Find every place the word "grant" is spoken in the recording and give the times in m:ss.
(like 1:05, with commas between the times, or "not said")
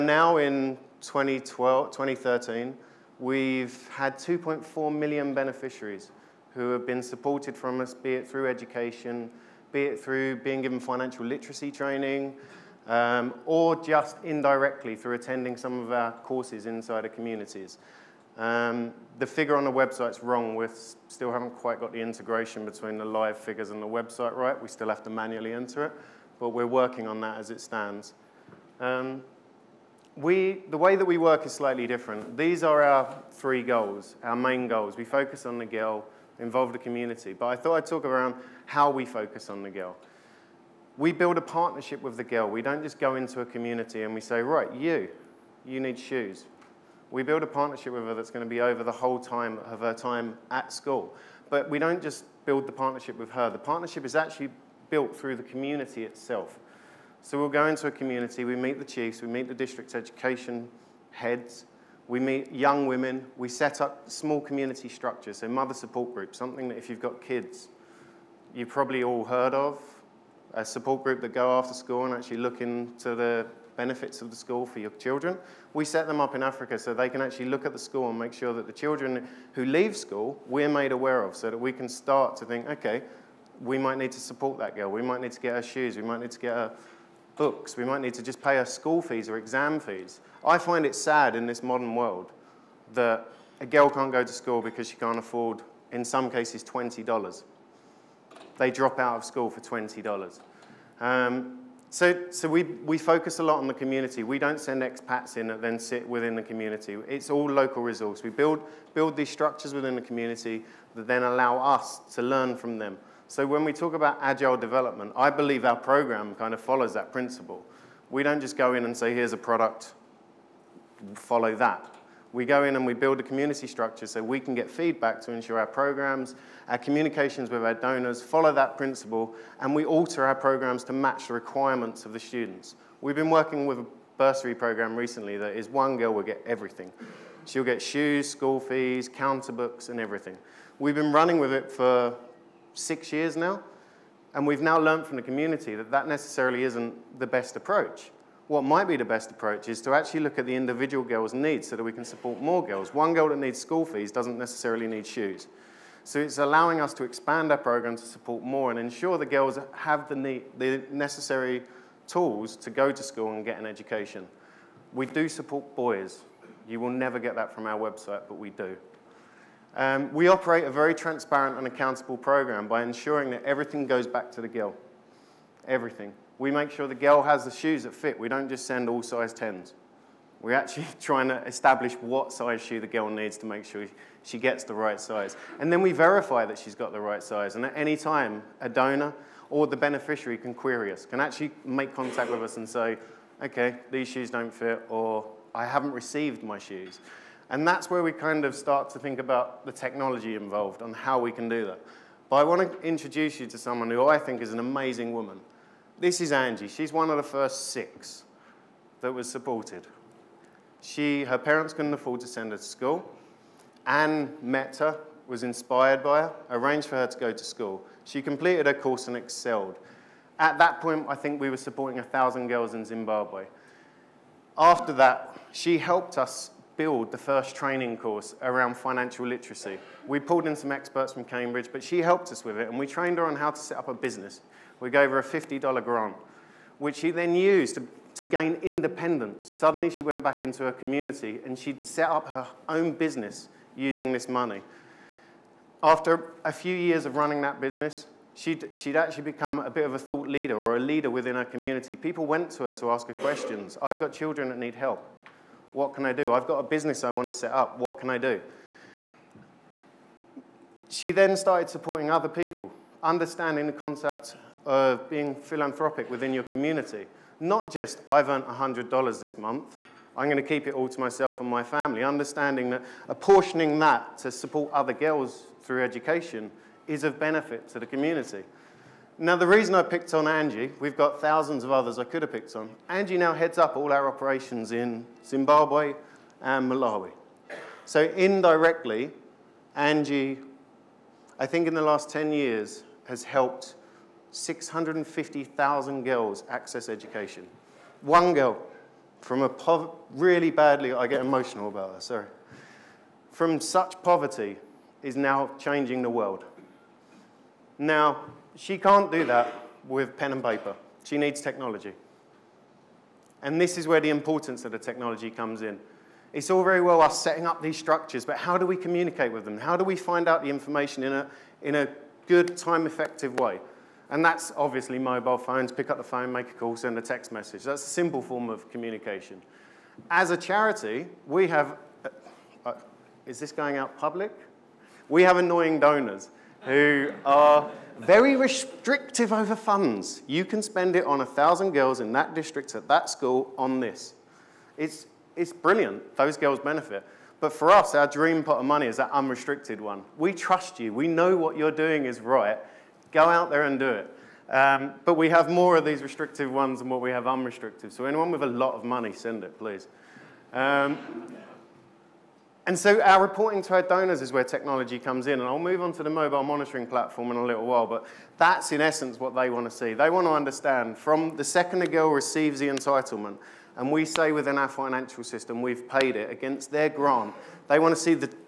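3:55, 6:16.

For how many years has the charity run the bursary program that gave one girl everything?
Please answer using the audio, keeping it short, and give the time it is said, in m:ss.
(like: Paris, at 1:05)
6 years, at 2:22.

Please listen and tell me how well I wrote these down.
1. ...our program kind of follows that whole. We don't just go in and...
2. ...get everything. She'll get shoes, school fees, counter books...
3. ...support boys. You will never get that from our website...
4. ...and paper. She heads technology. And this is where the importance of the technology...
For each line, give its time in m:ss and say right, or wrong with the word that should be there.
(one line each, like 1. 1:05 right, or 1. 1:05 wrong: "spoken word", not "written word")
1. 1:55 wrong: "principle", not "whole"
2. 2:16 right
3. 2:45 right
4. 5:10 wrong: "needs", not "heads".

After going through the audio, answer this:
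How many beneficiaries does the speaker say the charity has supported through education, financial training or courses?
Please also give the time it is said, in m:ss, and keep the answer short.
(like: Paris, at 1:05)
2.4 million, at 0:04.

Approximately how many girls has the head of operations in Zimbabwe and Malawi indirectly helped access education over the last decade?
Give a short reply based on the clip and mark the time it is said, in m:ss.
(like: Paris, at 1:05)
650,000, at 4:54.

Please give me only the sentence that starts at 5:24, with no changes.
And that's obviously mobile phones, pick up the phone, make a call, send a text message.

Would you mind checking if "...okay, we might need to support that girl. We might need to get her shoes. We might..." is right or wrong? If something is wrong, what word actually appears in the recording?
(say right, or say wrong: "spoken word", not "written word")
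right.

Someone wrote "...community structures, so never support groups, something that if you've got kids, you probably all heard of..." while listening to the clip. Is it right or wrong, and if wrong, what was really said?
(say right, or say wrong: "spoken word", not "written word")
wrong: "mother", not "never".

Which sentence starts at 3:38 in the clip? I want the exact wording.
She completed her course and excelled.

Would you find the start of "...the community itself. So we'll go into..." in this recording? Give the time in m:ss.
0:55.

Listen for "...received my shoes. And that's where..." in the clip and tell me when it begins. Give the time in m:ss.
3:15.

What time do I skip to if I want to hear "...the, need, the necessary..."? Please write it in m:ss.
2:40.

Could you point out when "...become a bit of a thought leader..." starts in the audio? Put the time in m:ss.
4:09.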